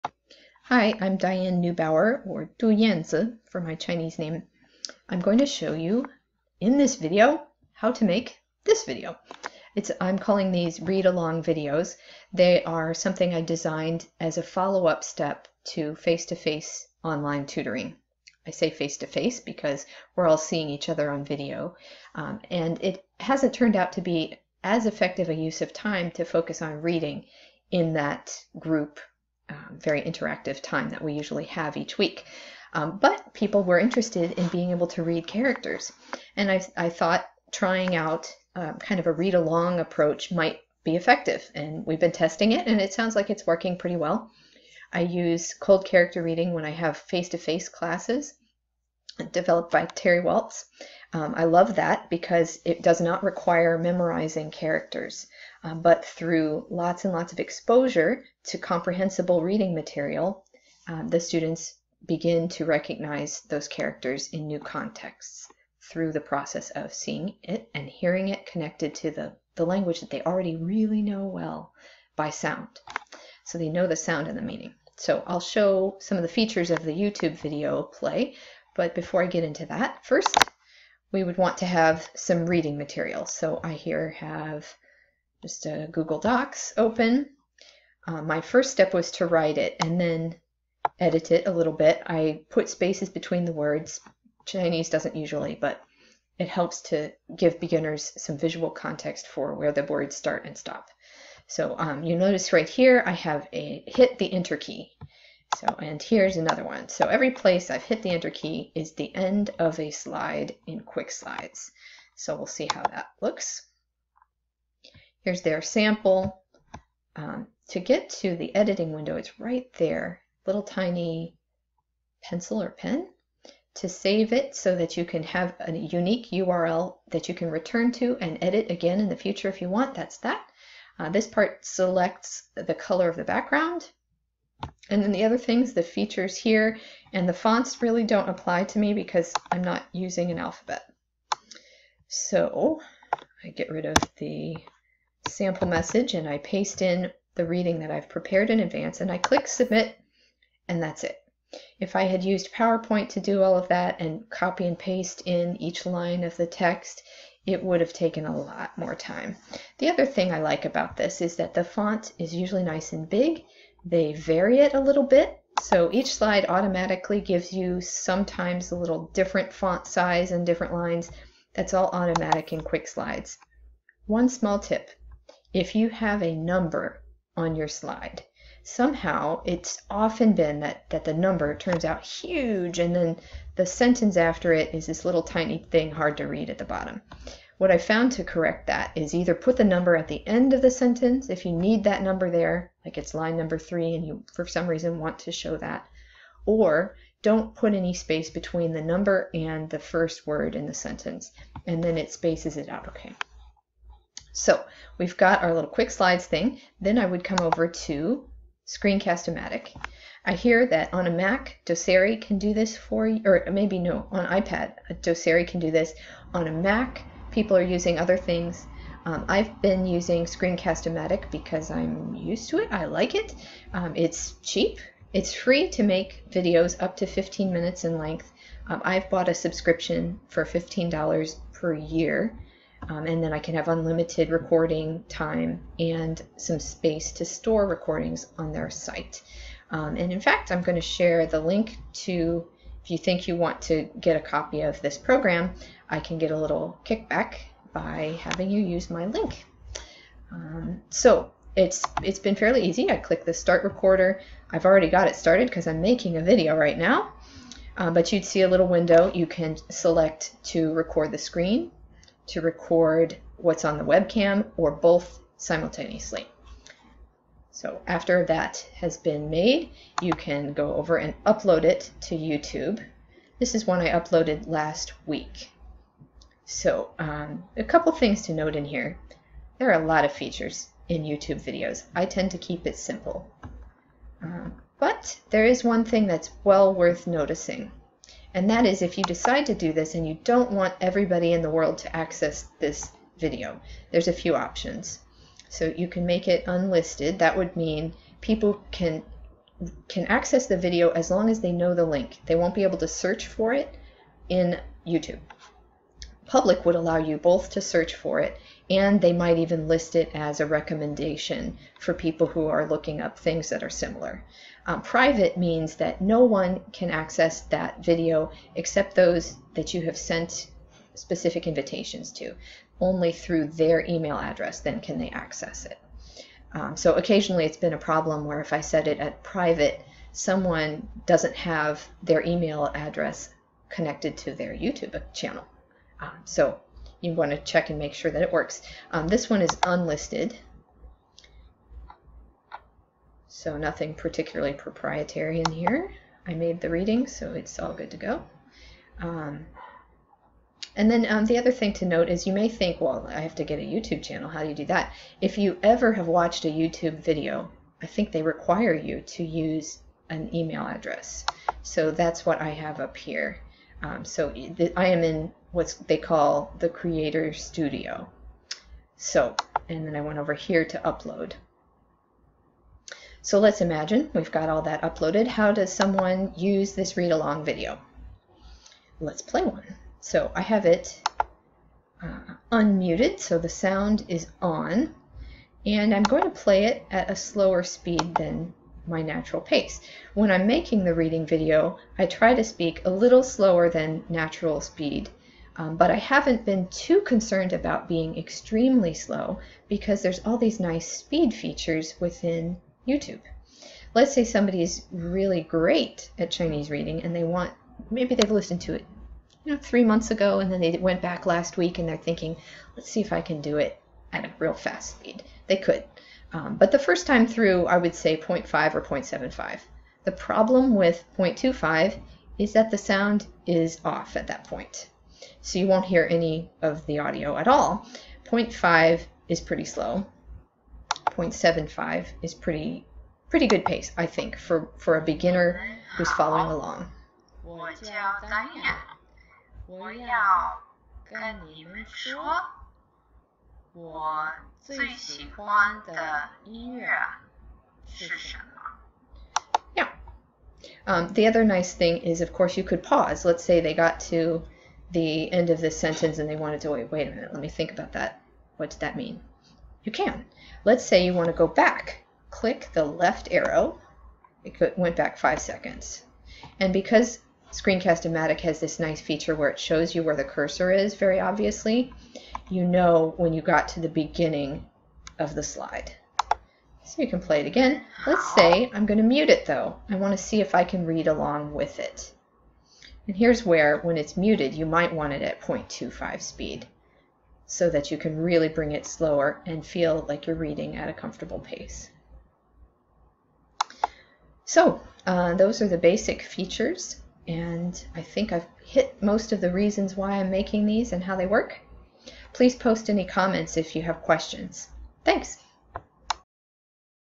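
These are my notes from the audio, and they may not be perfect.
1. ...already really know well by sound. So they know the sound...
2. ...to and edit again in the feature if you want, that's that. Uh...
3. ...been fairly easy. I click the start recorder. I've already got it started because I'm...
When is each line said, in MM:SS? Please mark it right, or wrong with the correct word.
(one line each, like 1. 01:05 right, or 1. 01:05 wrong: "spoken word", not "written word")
1. 01:10 right
2. 02:07 wrong: "future", not "feature"
3. 04:12 right.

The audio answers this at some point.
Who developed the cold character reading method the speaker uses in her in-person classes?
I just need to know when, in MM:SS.
00:49.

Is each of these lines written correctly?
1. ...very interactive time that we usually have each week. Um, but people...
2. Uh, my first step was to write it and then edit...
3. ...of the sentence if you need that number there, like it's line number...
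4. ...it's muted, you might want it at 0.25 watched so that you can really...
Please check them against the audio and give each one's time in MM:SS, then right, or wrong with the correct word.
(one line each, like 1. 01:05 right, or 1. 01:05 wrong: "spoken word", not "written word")
1. 00:29 right
2. 01:28 right
3. 03:10 right
4. 08:03 wrong: "speed", not "watched".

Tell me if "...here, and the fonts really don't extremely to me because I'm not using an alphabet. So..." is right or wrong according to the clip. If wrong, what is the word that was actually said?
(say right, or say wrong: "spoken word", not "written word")
wrong: "apply", not "extremely".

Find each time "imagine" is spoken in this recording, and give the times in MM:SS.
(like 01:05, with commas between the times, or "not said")
06:13.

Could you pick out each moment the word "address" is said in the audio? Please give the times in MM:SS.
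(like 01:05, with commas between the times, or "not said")
05:24, 05:32, 06:00.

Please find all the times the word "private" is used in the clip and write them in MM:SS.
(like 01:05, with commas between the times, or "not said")
05:14, 05:29.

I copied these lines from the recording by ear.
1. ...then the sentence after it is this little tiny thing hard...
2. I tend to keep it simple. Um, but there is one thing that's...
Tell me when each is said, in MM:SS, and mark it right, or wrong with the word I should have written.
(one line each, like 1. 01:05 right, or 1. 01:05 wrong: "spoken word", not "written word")
1. 03:02 right
2. 04:41 right.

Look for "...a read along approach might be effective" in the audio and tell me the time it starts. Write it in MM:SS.
00:39.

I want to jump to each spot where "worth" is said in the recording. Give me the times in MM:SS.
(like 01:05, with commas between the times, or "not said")
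04:46.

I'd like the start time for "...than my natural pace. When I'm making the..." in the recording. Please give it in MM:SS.
06:28.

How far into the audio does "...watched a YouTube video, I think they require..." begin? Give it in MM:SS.
05:56.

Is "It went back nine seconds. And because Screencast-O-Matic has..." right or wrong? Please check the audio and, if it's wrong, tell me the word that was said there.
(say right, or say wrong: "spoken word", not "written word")
wrong: "five", not "nine".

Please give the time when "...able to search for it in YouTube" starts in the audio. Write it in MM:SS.
05:02.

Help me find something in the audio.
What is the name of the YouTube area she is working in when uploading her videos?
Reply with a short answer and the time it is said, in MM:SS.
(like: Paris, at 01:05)
creator studio, at 06:06.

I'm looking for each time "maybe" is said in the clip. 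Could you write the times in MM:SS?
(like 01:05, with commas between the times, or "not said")
03:33, 06:47.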